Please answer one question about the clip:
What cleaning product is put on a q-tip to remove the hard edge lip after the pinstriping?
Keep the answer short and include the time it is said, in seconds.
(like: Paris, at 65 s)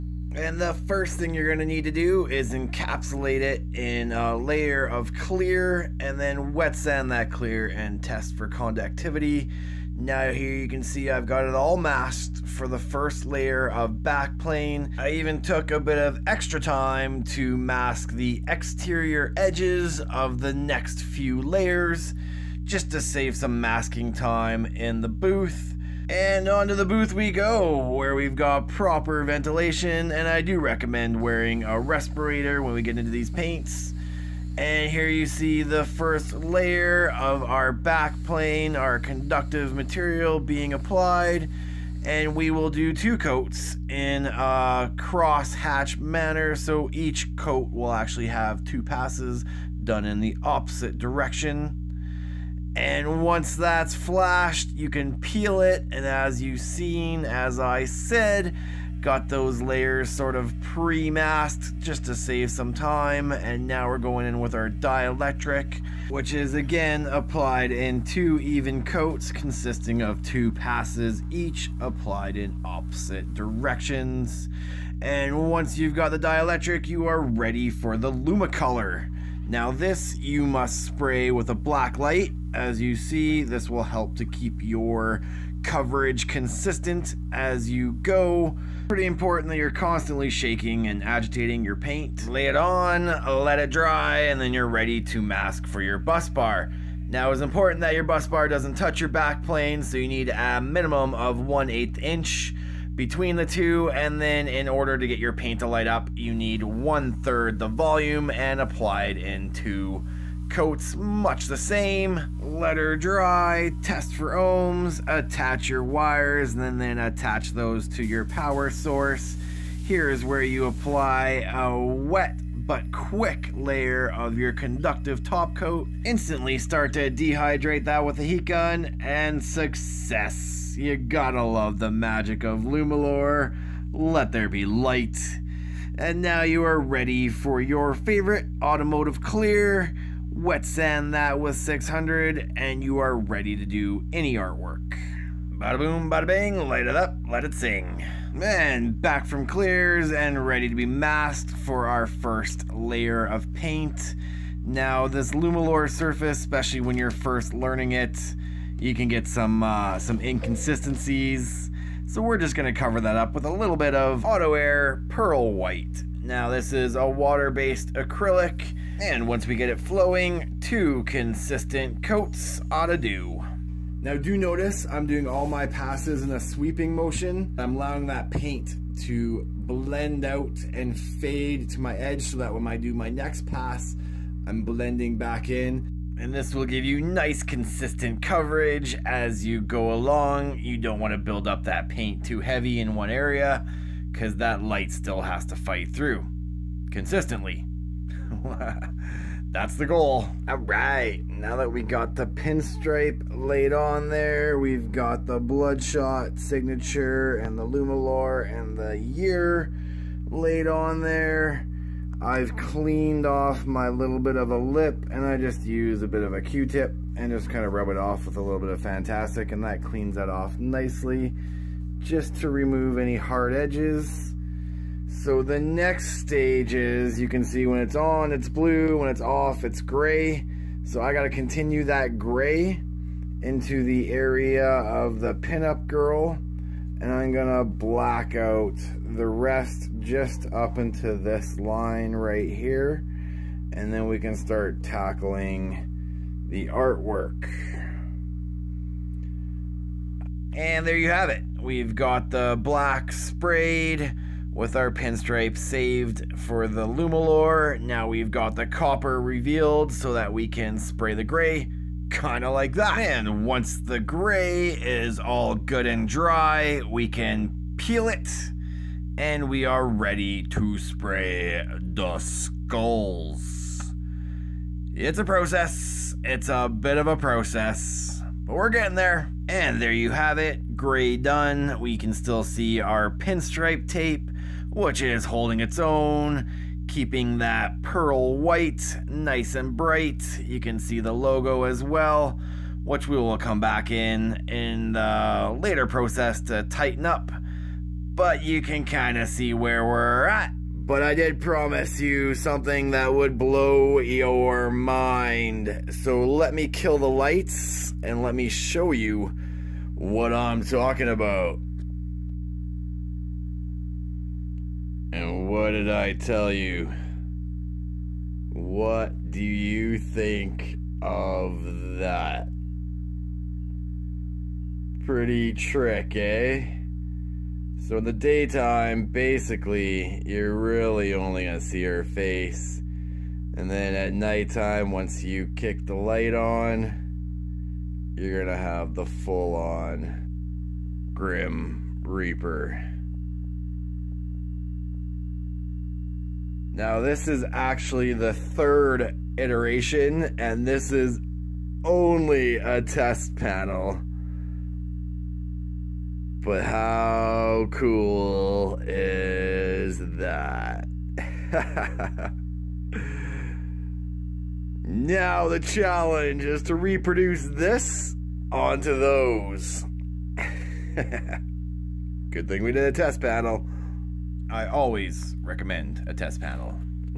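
Fantastik, at 218 s.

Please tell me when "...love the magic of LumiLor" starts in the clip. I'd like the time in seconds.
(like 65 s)
131 s.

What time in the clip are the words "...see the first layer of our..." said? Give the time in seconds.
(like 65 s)
35 s.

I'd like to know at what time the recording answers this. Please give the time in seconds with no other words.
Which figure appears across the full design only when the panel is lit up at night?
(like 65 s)
341 s.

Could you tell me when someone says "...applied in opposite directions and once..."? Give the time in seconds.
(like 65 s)
71 s.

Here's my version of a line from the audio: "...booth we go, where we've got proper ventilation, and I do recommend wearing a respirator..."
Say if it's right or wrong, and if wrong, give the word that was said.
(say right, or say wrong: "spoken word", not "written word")
right.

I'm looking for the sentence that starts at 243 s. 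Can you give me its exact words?
And then we can start tackling the artwork.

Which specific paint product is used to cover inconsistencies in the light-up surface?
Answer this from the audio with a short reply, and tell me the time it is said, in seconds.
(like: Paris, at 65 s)
Auto Air Pearl White, at 164 s.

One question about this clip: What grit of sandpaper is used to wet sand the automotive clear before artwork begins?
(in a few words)
600.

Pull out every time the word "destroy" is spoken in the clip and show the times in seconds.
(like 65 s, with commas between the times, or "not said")
not said.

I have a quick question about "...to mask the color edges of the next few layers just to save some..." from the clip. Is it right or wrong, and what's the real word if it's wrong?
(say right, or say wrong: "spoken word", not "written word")
wrong: "exterior", not "color".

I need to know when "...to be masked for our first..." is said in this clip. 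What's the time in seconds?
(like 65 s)
150 s.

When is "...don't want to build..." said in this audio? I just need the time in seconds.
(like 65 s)
190 s.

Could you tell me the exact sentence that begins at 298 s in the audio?
But you can kind of see where we're at but I did promise you something that would blow your mind.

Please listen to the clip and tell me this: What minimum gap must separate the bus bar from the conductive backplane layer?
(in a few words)
1/8 inch.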